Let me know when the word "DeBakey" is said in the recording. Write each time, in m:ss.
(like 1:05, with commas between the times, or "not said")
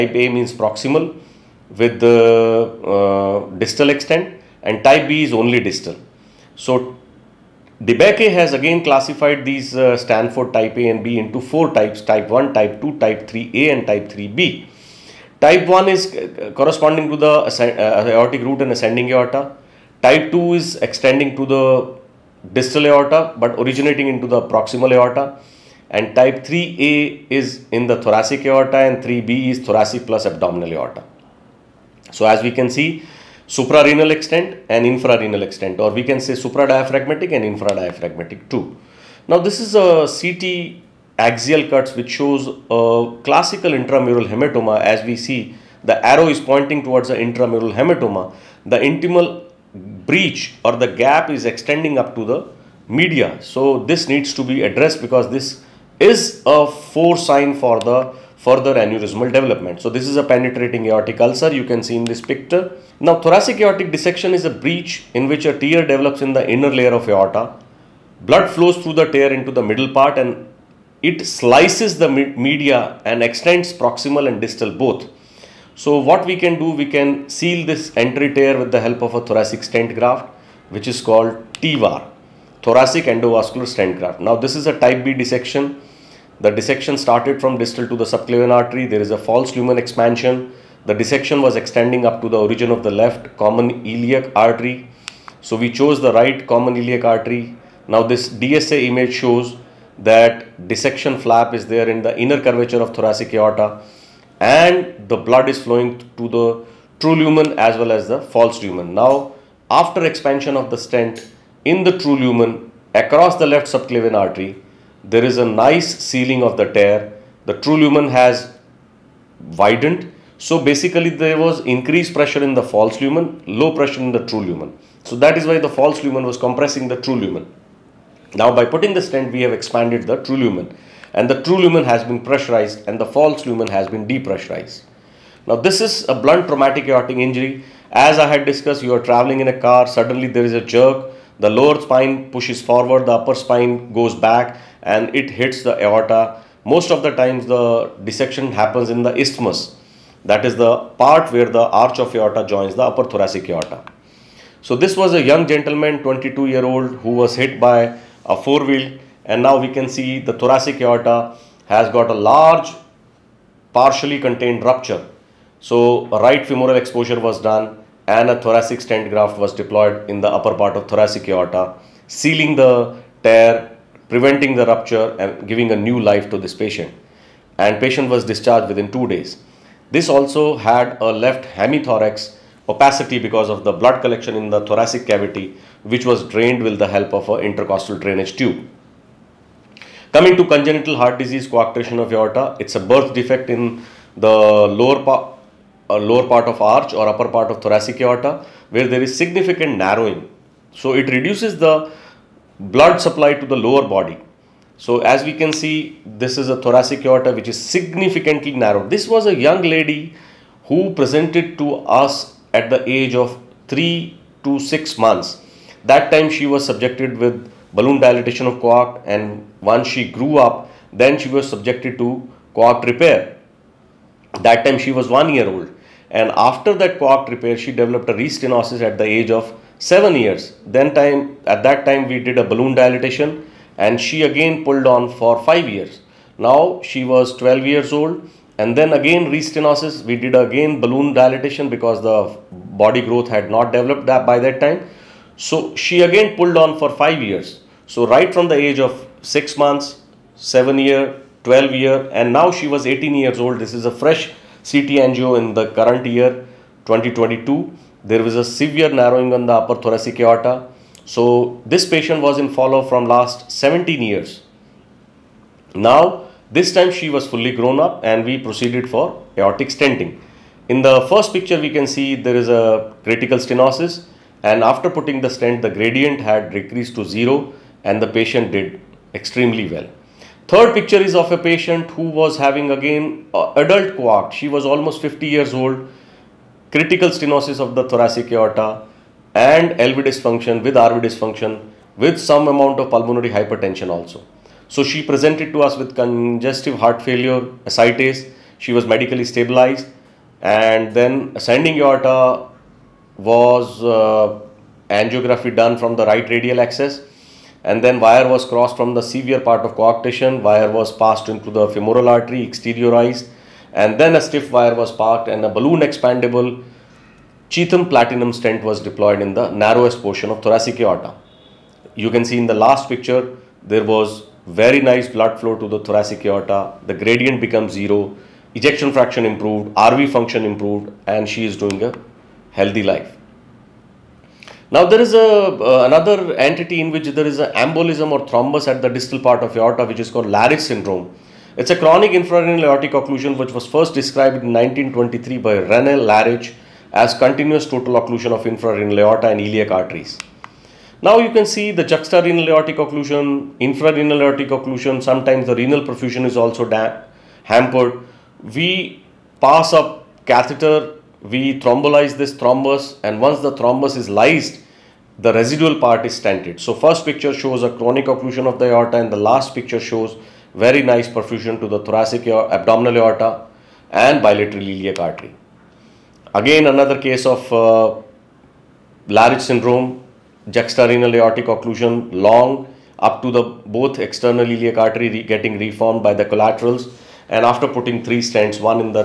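0:07.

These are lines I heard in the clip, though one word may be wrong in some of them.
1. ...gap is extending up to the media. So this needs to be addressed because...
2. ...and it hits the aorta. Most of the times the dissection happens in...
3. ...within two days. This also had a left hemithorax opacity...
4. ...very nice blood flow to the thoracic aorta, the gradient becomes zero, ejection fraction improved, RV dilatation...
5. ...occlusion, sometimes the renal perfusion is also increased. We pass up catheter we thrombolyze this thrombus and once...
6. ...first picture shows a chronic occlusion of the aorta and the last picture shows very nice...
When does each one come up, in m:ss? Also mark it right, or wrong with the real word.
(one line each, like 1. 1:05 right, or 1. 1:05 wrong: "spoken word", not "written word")
1. 0:50 right
2. 2:24 right
3. 2:58 right
4. 5:24 wrong: "function", not "dilatation"
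5. 5:54 wrong: "hampered", not "increased"
6. 6:06 right.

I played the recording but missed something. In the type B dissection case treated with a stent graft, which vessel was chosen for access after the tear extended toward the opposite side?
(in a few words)
Right common iliac artery.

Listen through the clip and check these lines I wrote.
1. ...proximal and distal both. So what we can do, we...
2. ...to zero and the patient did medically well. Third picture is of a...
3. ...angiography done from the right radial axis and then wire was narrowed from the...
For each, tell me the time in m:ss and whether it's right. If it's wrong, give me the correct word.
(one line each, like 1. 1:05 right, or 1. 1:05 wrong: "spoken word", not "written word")
1. 1:13 right
2. 4:36 wrong: "extremely", not "medically"
3. 5:04 wrong: "crossed", not "narrowed".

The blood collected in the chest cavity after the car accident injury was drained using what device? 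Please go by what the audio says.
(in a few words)
Intercostal drainage tube.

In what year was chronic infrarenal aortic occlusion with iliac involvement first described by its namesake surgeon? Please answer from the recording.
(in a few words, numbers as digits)
1923.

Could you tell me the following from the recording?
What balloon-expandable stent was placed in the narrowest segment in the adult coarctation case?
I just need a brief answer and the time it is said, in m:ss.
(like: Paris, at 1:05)
Cheatham platinum stent, at 5:17.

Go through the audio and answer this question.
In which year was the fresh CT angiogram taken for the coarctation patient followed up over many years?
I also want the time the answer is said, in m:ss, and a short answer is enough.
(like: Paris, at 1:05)
2022, at 4:16.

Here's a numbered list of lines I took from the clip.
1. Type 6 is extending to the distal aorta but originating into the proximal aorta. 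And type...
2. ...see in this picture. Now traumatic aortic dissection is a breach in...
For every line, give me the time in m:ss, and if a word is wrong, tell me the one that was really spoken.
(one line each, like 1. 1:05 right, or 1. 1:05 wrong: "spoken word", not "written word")
1. 0:20 wrong: "2", not "6"
2. 1:01 wrong: "thoracic", not "traumatic".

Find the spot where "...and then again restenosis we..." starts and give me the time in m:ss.
3:58.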